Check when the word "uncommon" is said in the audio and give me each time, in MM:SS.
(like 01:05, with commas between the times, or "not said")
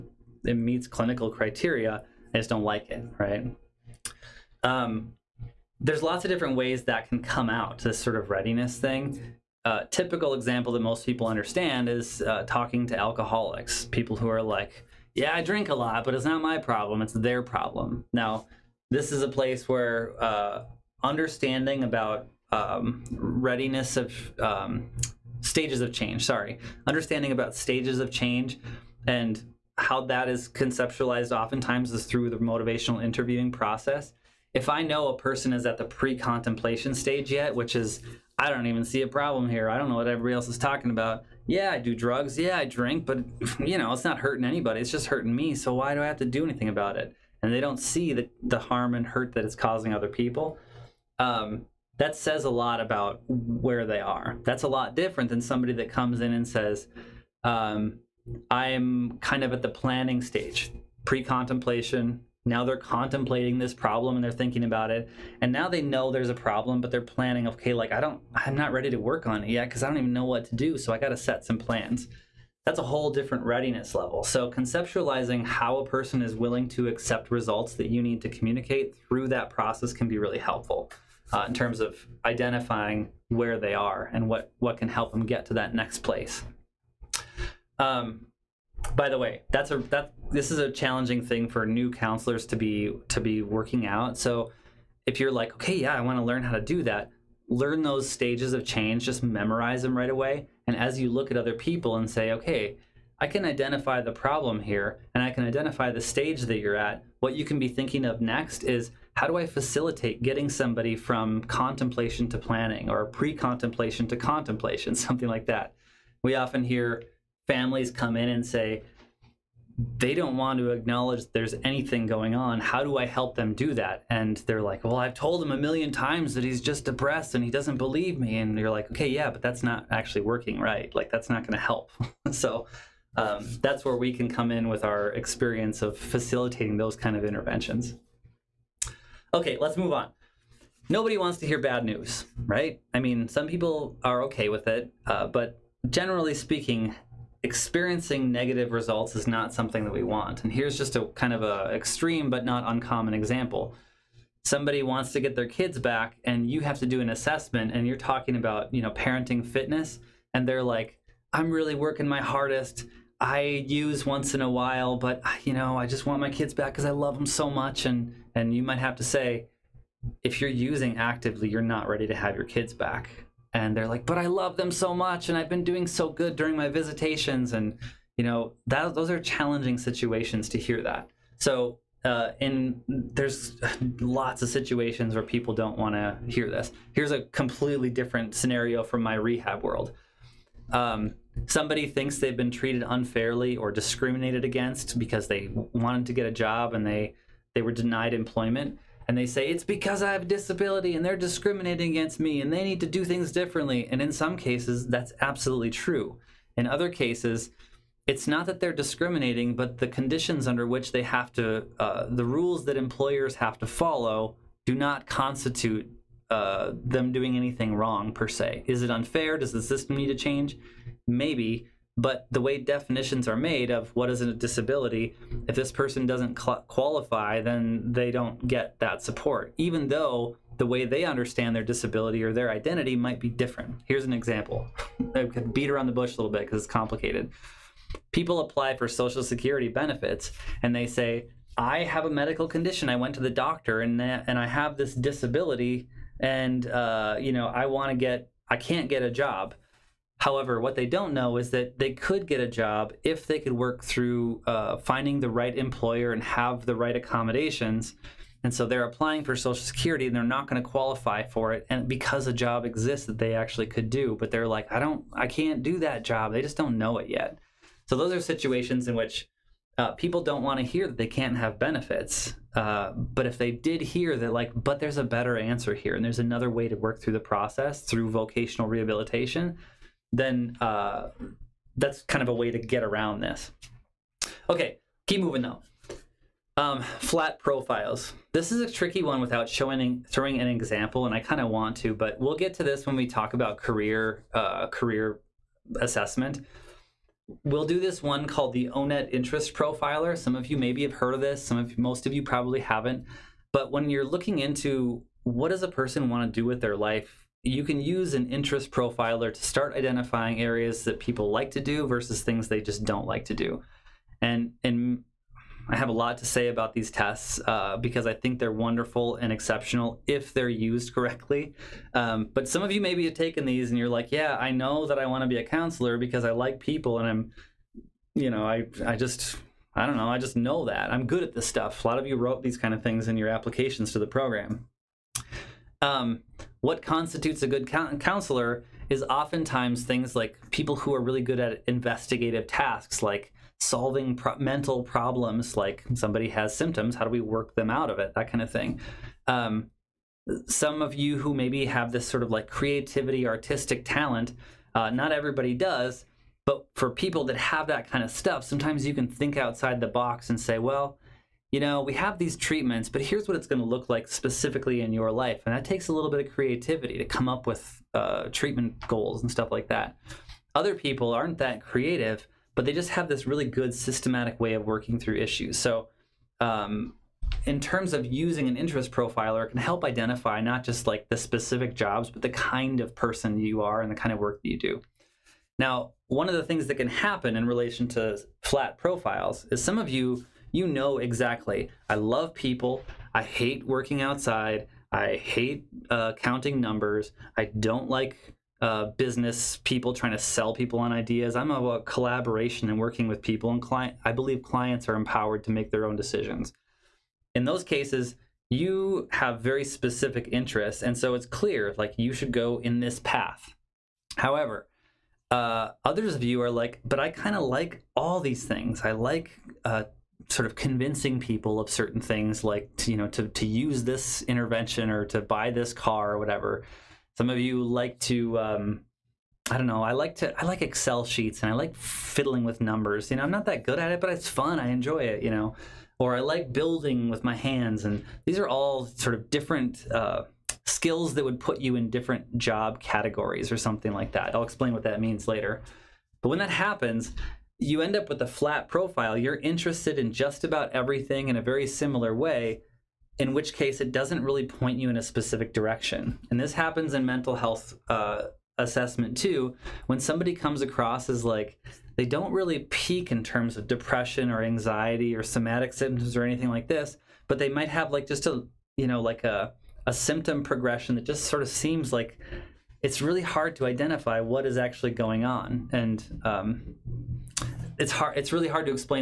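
02:32.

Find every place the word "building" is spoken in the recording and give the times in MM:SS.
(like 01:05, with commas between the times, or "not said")
07:16.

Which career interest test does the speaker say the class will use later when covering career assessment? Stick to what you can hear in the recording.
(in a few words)
ONET Interest Profiler.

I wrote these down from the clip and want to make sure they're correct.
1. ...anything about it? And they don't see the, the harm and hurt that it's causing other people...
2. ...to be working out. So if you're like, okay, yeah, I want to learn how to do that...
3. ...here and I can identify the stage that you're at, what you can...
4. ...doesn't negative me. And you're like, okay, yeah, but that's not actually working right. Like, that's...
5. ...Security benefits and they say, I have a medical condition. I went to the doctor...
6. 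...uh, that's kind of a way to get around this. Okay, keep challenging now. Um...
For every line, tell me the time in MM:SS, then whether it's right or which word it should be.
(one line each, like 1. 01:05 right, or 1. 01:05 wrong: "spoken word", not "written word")
1. 00:46 right
2. 01:33 right
3. 01:44 right
4. 02:07 wrong: "believe", not "negative"
5. 03:59 right
6. 04:40 wrong: "moving", not "challenging".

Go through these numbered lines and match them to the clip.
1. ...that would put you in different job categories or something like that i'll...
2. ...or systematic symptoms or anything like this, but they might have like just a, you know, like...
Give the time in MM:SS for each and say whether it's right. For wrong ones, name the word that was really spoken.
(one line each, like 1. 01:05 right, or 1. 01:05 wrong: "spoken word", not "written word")
1. 07:21 right
2. 07:45 wrong: "somatic", not "systematic".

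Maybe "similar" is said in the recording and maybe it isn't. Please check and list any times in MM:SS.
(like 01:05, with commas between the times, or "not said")
07:31.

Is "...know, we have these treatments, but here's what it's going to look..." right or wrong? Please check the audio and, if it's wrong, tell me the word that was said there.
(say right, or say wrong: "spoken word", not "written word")
right.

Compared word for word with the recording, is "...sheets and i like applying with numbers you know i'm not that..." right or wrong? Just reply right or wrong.
wrong.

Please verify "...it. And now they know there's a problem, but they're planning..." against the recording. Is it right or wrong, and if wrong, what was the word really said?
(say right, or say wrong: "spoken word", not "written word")
right.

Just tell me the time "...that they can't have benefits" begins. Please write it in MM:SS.
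04:30.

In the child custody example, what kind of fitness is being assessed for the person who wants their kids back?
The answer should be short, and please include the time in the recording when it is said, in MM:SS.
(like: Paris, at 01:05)
Parenting fitness, at 02:38.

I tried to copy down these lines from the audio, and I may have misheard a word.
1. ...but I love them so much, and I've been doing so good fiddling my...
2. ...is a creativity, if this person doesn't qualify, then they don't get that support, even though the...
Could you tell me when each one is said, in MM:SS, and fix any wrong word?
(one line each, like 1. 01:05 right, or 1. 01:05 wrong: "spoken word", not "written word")
1. 02:54 wrong: "during", not "fiddling"
2. 03:44 wrong: "disability", not "creativity".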